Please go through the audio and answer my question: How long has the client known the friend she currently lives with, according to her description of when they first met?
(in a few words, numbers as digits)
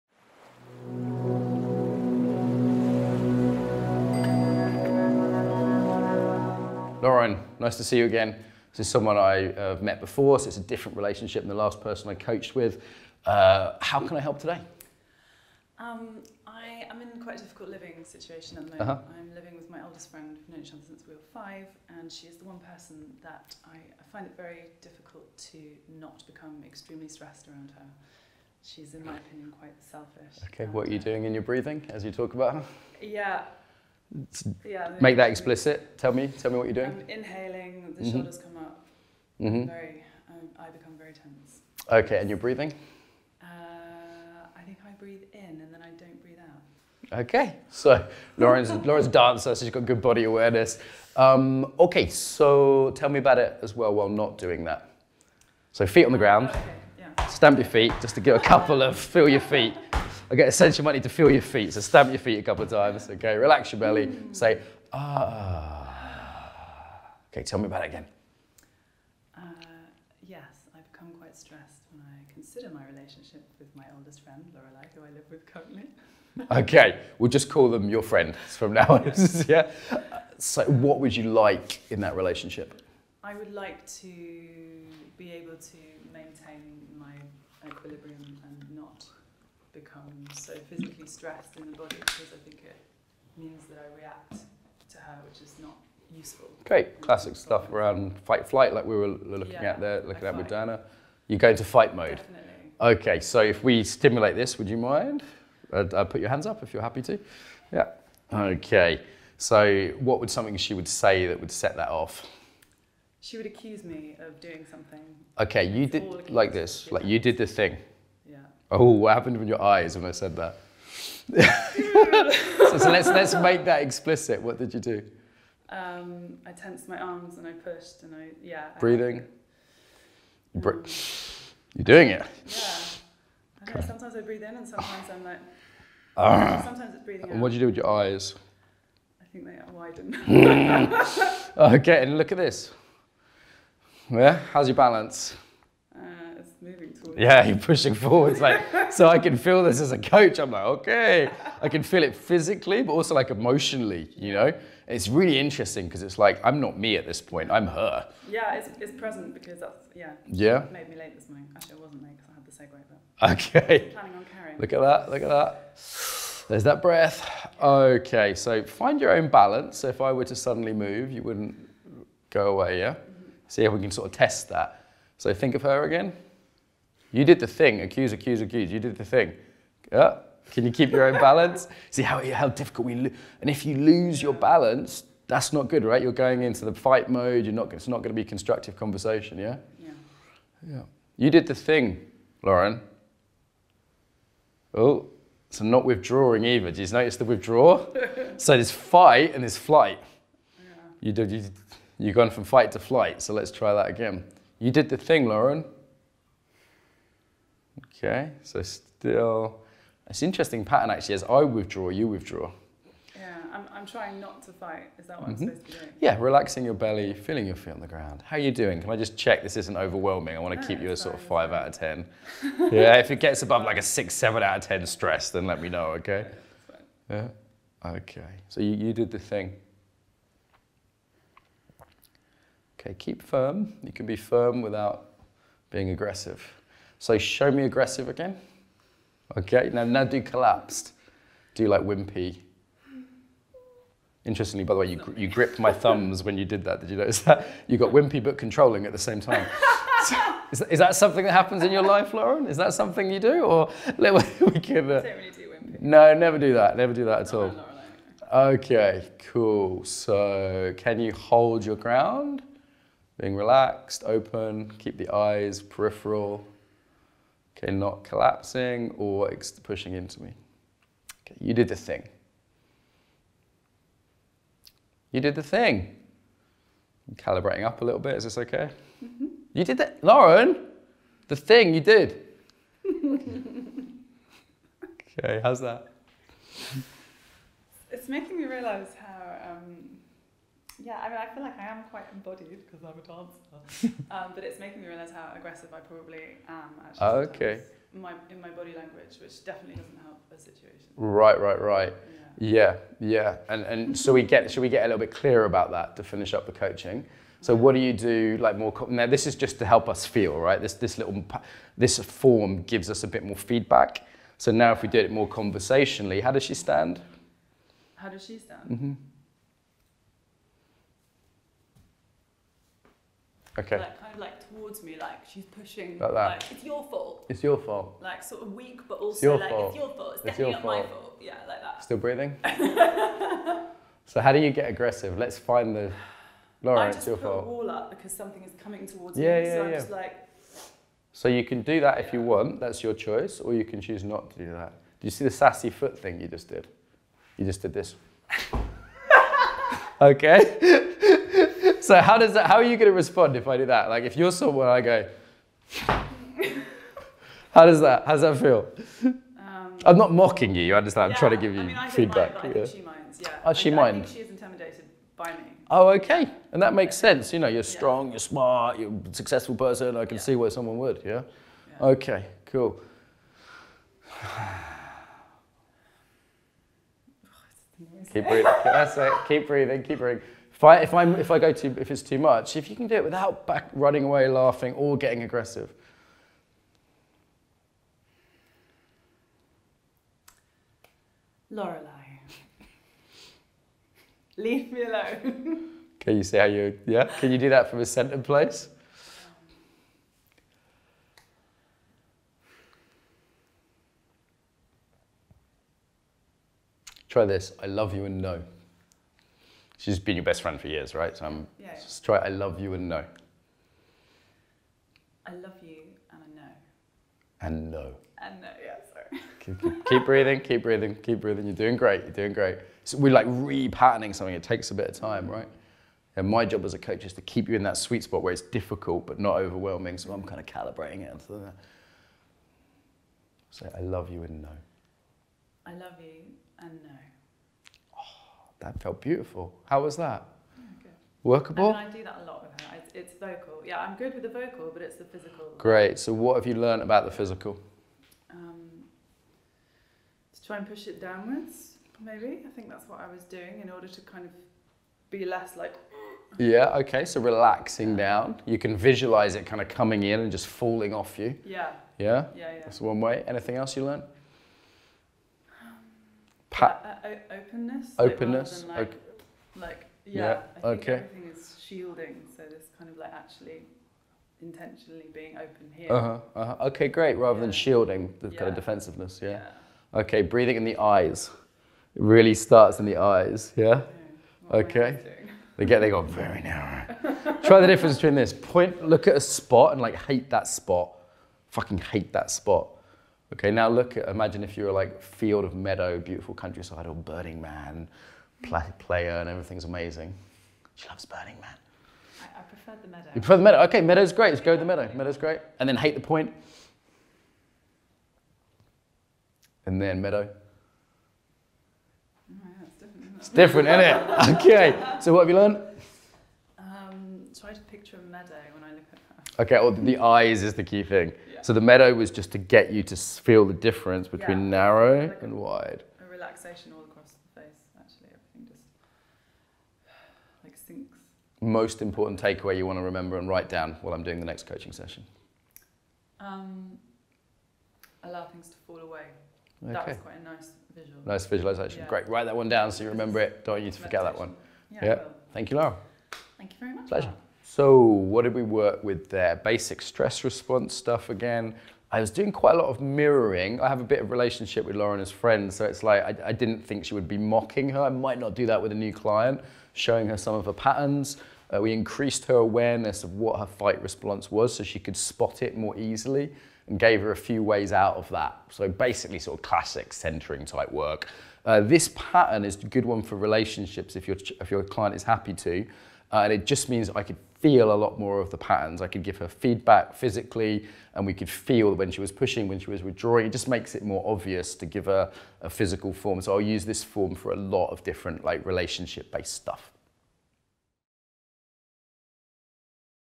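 Since age 5.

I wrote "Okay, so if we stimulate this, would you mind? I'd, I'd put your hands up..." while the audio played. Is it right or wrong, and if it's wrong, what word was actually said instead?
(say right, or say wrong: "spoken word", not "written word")
right.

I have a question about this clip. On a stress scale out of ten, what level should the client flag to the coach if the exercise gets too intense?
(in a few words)
6 or 7.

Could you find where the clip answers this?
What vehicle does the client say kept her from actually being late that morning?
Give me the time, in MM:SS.
02:43.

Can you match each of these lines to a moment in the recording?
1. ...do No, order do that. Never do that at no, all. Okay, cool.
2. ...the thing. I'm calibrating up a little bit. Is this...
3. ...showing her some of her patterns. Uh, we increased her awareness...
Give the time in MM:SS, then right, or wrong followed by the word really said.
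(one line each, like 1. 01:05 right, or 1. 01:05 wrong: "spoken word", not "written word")
1. 04:15 wrong: "never", not "order"
2. 04:35 right
3. 09:19 right.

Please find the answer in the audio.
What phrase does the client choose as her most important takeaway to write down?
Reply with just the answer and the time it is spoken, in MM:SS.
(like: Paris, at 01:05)
Allow things to fall away, at 08:58.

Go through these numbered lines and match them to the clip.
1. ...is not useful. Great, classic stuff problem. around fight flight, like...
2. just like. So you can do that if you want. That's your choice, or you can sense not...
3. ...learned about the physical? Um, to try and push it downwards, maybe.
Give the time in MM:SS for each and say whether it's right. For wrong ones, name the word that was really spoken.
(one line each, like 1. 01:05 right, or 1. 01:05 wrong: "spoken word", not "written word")
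1. 01:35 right
2. 05:39 wrong: "choose", not "sense"
3. 07:26 right.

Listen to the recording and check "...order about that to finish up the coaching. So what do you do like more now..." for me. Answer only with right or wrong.
wrong.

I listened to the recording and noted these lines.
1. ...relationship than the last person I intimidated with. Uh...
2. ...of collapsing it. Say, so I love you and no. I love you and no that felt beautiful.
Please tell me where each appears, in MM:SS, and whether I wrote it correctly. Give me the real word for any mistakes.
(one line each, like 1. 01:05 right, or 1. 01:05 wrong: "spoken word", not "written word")
1. 00:10 wrong: "coached", not "intimidated"
2. 07:10 wrong: "calibrating", not "collapsing".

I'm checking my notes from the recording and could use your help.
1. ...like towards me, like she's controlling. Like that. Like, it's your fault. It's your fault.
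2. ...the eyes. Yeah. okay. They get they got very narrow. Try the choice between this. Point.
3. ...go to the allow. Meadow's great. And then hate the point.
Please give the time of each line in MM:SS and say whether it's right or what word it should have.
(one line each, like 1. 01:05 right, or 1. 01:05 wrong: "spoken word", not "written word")
1. 05:24 wrong: "pushing", not "controlling"
2. 08:02 wrong: "difference", not "choice"
3. 08:24 wrong: "meadow", not "allow".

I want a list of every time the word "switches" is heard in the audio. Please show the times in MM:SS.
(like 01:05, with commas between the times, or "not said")
not said.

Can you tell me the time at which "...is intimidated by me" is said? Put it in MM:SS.
06:04.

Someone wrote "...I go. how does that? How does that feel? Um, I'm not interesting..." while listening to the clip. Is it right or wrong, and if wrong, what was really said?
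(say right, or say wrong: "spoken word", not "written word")
wrong: "mocking", not "interesting".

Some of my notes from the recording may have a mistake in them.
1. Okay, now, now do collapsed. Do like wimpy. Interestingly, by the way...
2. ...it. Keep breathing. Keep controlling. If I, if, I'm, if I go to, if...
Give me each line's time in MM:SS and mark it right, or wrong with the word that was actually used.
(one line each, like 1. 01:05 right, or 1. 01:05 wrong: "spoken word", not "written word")
1. 03:59 right
2. 06:18 wrong: "breathing", not "controlling".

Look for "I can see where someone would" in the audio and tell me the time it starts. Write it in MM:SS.
06:09.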